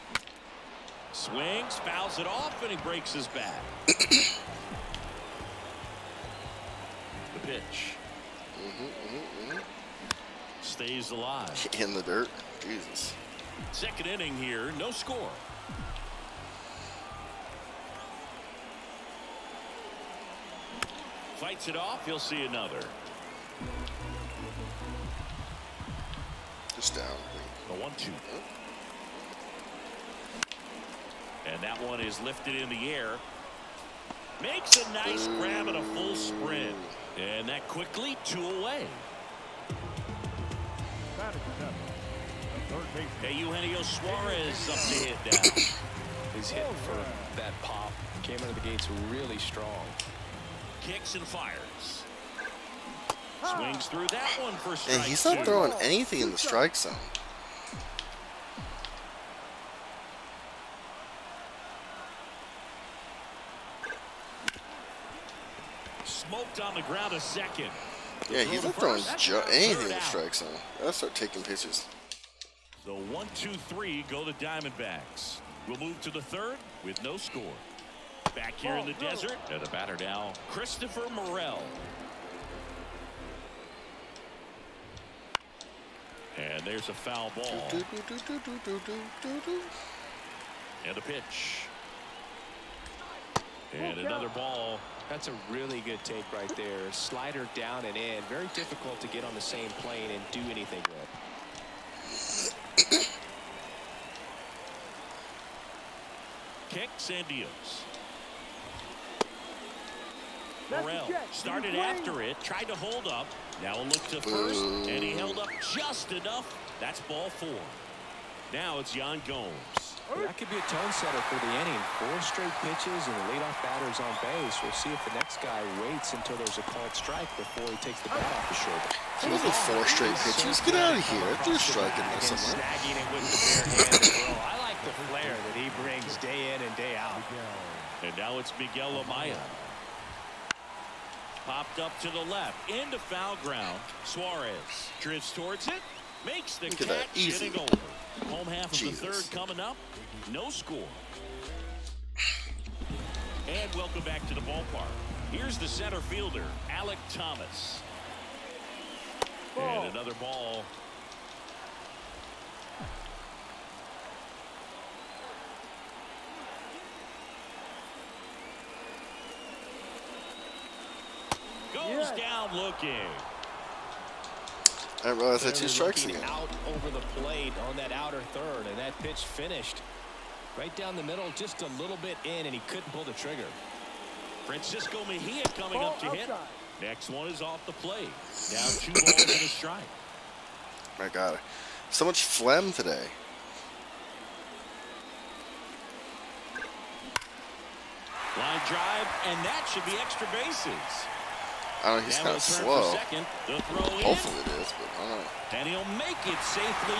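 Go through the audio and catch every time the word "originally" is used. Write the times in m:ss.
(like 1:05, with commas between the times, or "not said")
not said.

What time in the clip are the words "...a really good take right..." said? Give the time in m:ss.
1:35.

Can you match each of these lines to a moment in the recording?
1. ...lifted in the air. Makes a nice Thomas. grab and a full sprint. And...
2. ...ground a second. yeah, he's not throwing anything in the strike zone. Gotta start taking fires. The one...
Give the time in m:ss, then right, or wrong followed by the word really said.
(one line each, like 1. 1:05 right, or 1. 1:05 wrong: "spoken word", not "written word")
1. 0:32 wrong: "Ooh", not "Thomas"
2. 1:06 wrong: "pitches", not "fires".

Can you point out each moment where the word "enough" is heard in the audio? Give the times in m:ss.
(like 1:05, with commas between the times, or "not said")
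1:56.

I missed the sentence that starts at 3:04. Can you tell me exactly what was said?
Francisco Mejia coming Ball up to oh, outside.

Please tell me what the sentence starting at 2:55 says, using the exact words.
I realize that two strikes again.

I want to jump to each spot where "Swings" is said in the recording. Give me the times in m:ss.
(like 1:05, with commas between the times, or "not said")
0:01, 0:53.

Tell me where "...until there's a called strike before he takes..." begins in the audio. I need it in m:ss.
2:06.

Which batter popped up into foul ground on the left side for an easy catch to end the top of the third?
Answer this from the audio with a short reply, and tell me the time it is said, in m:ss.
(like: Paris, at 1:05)
Miguel Amaya, at 2:18.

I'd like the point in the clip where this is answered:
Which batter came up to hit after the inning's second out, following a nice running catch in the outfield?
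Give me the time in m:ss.
0:43.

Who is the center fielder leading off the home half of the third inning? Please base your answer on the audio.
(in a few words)
Alek Thomas.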